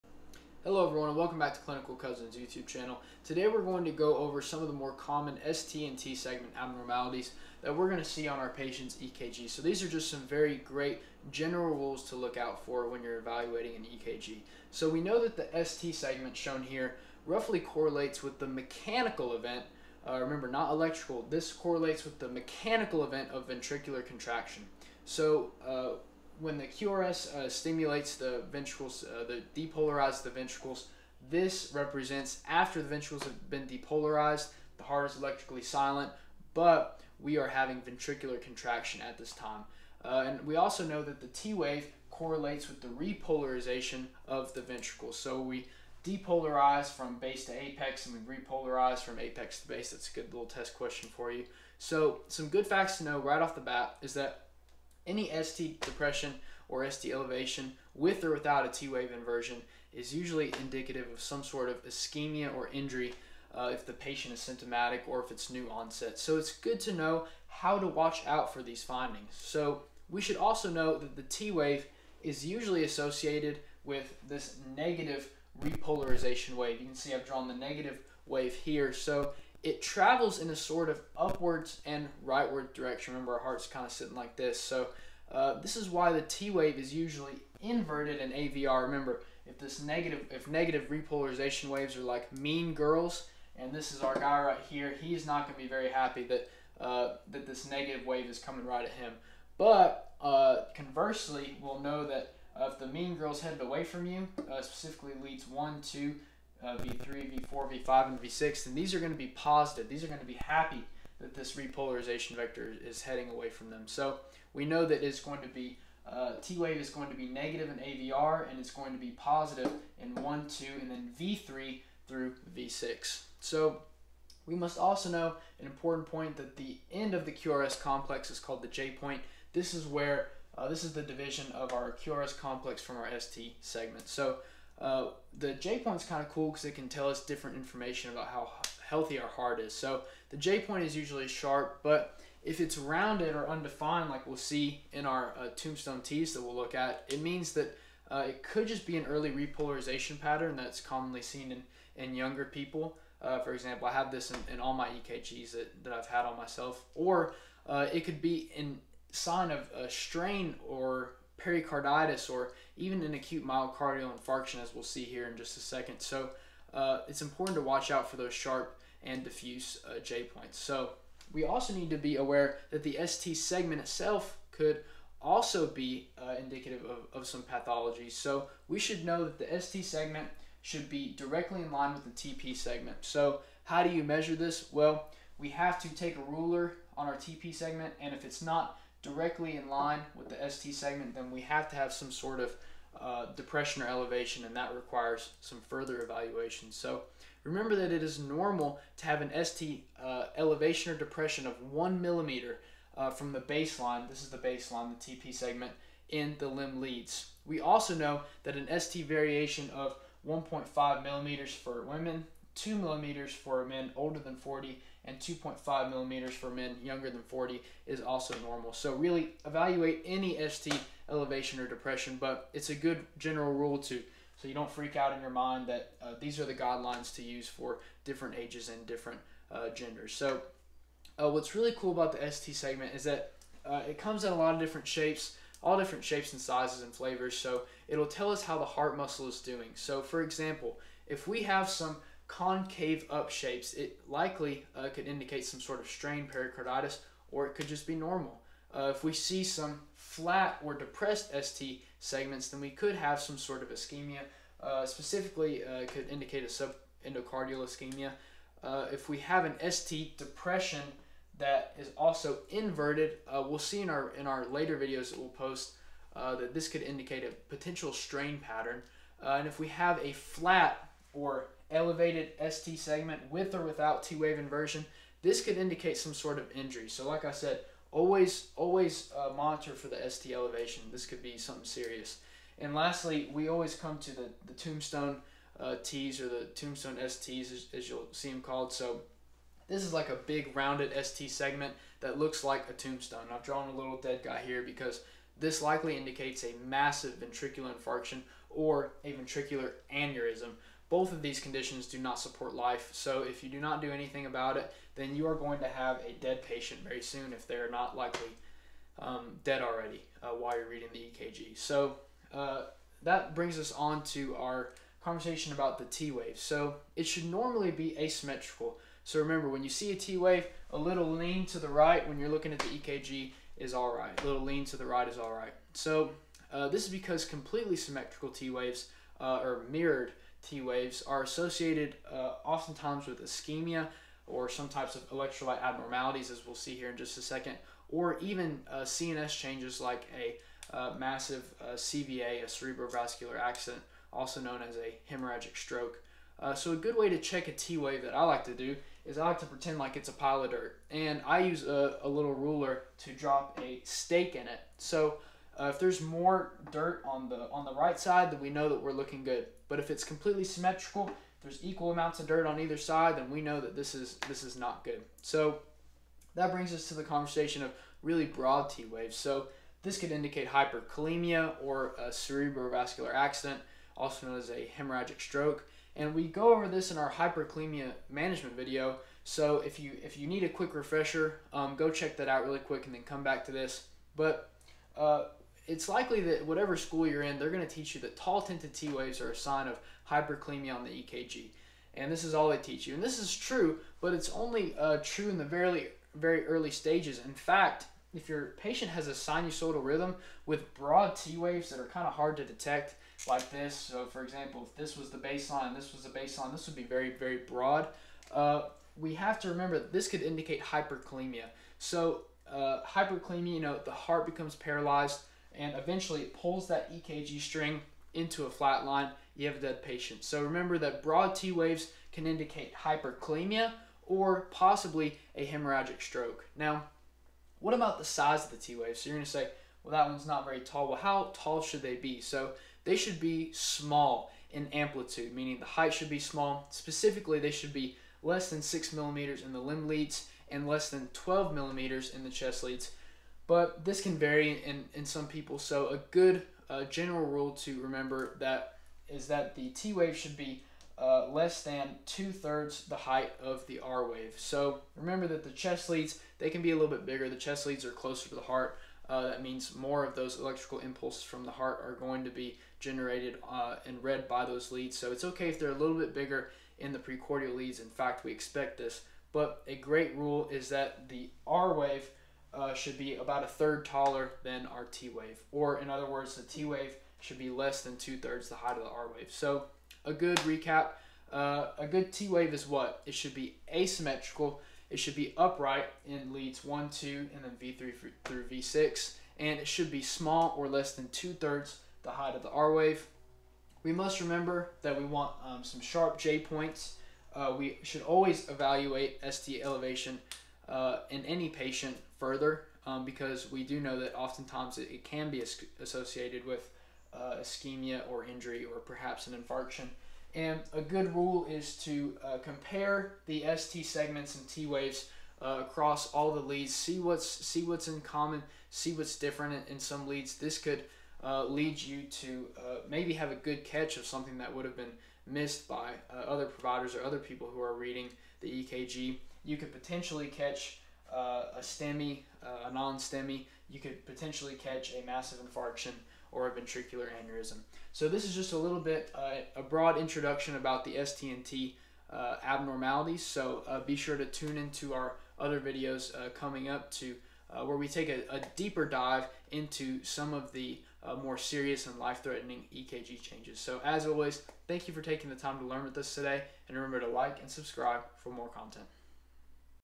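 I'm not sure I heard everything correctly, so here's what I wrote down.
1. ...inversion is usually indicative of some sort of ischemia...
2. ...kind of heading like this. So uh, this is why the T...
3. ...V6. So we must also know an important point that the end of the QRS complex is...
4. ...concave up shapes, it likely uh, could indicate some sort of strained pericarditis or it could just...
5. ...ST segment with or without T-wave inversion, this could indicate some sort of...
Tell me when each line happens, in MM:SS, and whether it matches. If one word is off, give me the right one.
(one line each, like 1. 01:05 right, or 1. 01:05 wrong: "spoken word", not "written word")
1. 00:59 right
2. 01:23 wrong: "sitting", not "heading"
3. 02:02 right
4. 04:02 right
5. 04:32 right.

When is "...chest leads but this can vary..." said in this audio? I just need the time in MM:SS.
07:22.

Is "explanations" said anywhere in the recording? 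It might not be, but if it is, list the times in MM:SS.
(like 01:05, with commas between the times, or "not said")
not said.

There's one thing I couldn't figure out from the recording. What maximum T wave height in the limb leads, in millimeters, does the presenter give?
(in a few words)
6 millimeters.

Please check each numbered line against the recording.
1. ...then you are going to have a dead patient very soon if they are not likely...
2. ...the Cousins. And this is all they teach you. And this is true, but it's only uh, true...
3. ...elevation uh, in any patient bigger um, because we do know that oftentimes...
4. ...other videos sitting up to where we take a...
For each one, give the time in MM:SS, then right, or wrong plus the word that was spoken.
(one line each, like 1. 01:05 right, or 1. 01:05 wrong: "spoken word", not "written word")
1. 05:04 right
2. 06:30 wrong: "EKG", not "Cousins"
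3. 08:19 wrong: "further", not "bigger"
4. 09:05 wrong: "coming", not "sitting".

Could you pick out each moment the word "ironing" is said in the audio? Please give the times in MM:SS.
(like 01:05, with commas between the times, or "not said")
not said.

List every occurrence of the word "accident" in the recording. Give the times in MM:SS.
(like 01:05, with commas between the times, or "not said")
05:43, 06:13.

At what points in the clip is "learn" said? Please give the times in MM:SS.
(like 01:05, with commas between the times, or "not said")
09:15.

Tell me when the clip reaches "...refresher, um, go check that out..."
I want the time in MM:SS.
06:20.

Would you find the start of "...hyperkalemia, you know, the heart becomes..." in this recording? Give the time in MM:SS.
06:52.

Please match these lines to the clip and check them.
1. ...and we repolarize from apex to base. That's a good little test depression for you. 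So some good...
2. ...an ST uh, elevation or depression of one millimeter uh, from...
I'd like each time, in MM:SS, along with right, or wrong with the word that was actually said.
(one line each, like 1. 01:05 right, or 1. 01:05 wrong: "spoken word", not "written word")
1. 00:48 wrong: "question", not "depression"
2. 03:19 right.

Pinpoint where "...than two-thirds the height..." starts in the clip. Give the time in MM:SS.
07:31.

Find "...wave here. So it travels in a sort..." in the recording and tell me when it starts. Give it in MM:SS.
01:18.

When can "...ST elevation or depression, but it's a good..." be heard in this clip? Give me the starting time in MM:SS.
03:40.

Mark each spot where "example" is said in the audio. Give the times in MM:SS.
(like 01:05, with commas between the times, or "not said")
02:33, 04:00, 06:44.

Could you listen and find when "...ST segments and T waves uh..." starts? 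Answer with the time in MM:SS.
08:33.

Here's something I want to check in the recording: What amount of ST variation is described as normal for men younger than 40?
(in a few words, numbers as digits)
2.5 millimeters.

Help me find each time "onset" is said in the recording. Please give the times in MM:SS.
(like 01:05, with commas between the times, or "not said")
01:05.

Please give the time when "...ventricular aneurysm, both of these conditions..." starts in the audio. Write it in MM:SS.
04:59.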